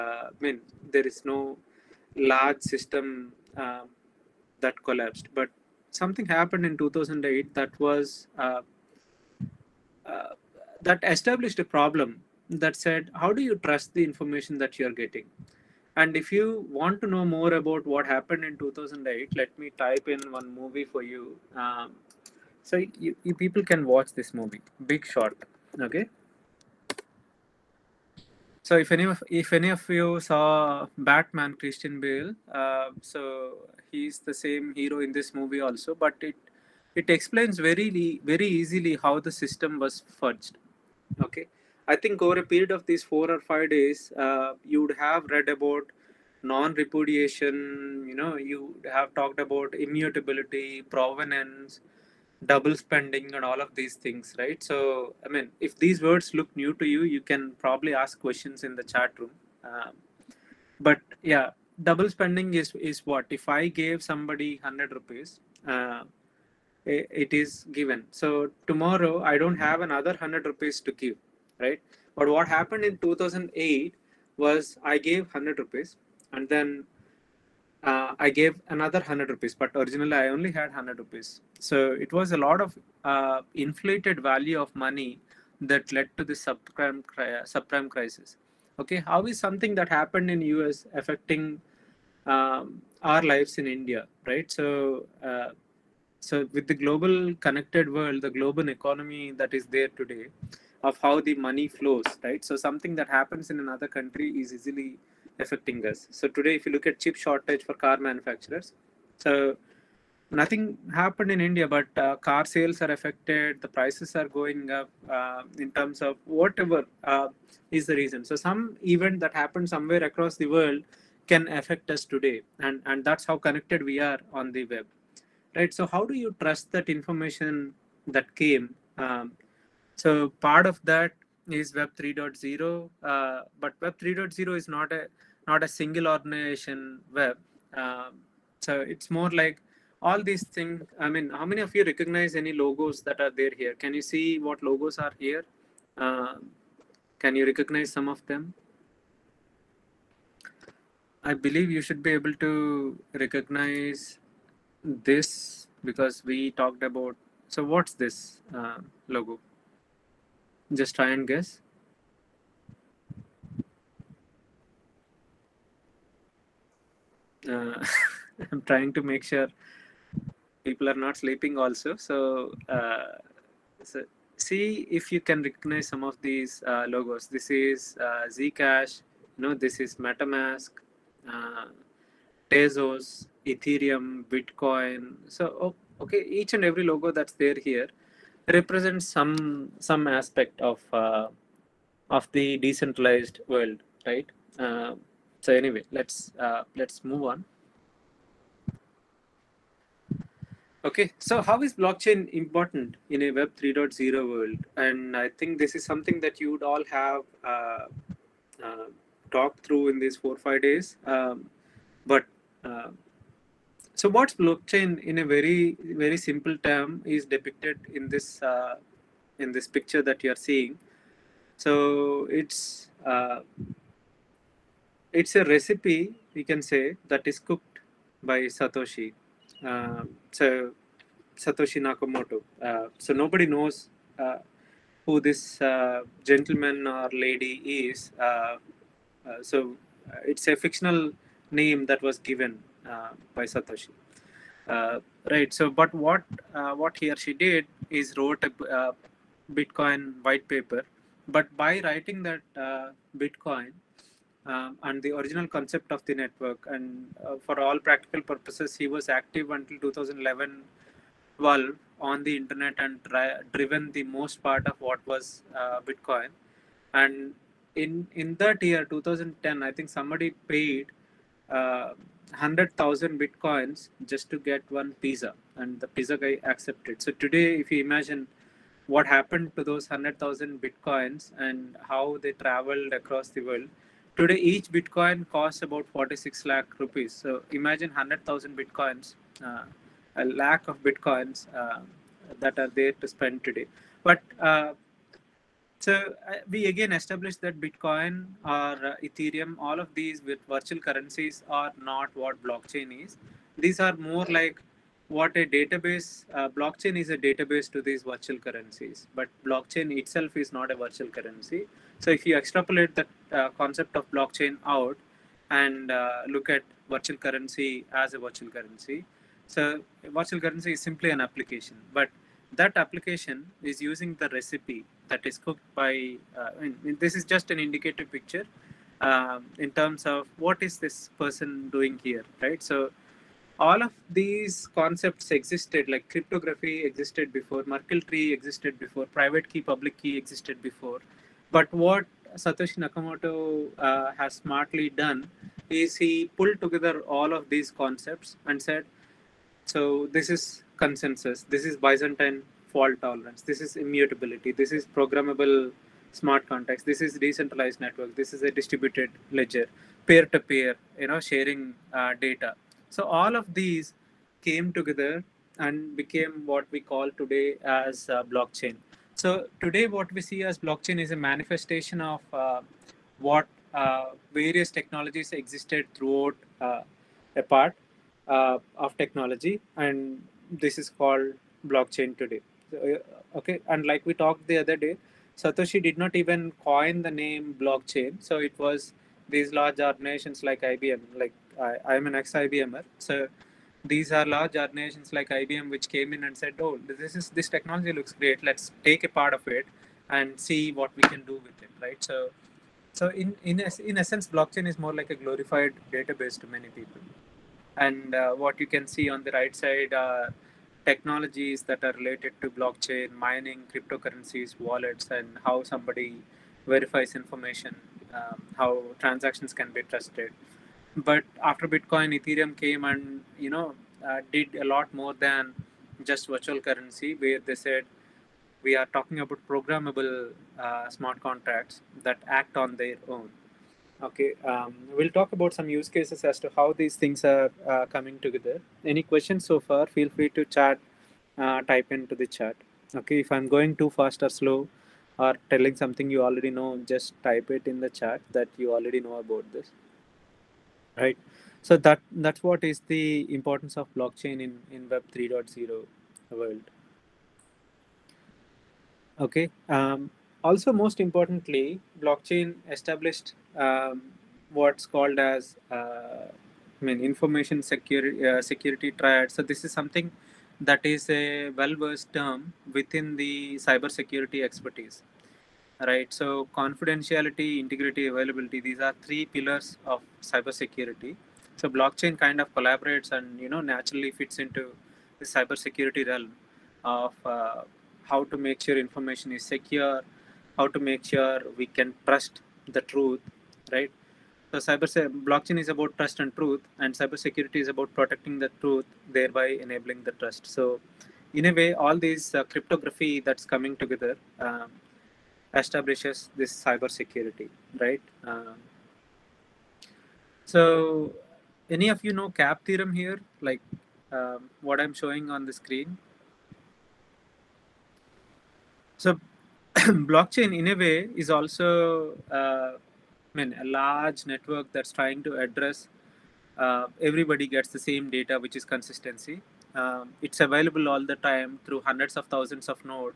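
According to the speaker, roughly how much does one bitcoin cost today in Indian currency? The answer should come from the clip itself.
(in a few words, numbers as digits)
46 lakh rupees.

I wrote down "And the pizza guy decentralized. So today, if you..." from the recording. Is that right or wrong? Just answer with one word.
wrong.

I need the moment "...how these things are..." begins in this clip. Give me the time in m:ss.
7:16.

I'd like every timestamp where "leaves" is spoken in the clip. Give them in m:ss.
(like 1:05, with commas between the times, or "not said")
not said.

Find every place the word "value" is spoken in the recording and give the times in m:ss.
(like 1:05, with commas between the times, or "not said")
1:24.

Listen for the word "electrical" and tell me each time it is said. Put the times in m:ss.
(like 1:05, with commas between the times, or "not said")
not said.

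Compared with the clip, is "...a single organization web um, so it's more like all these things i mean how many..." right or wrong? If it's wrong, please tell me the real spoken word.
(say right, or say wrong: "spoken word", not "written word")
right.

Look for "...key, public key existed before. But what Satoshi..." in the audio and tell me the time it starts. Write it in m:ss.
5:39.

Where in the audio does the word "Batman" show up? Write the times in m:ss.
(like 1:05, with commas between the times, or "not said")
0:30.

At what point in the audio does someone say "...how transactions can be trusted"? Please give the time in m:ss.
6:58.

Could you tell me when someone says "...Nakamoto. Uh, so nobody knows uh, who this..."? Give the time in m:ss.
3:51.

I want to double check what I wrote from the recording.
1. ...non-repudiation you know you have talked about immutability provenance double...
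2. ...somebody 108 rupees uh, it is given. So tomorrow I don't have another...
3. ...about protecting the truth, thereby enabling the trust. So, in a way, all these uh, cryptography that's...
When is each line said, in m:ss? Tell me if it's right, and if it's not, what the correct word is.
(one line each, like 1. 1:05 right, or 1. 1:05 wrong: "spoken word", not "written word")
1. 0:46 right
2. 1:04 wrong: "100", not "108"
3. 8:17 right.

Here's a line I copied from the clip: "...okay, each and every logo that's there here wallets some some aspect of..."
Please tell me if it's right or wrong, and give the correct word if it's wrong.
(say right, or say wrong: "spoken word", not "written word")
wrong: "represents", not "wallets".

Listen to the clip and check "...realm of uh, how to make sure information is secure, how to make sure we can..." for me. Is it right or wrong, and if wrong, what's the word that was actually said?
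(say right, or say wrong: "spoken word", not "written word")
right.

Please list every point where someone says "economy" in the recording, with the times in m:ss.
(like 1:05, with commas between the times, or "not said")
1:38.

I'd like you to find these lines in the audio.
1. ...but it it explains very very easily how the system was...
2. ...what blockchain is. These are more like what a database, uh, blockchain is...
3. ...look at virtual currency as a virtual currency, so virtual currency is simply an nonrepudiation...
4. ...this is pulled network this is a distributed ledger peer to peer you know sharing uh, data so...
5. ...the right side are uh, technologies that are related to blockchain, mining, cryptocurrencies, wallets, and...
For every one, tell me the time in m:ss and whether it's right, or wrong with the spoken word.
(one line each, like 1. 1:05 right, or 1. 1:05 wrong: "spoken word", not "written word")
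1. 0:35 right
2. 5:02 right
3. 5:16 wrong: "application", not "nonrepudiation"
4. 5:56 wrong: "decentralized", not "pulled"
5. 6:49 right.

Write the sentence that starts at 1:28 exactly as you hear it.
Okay, how is something that happened in US affecting um, our lives in India, right?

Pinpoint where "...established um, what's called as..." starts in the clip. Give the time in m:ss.
7:42.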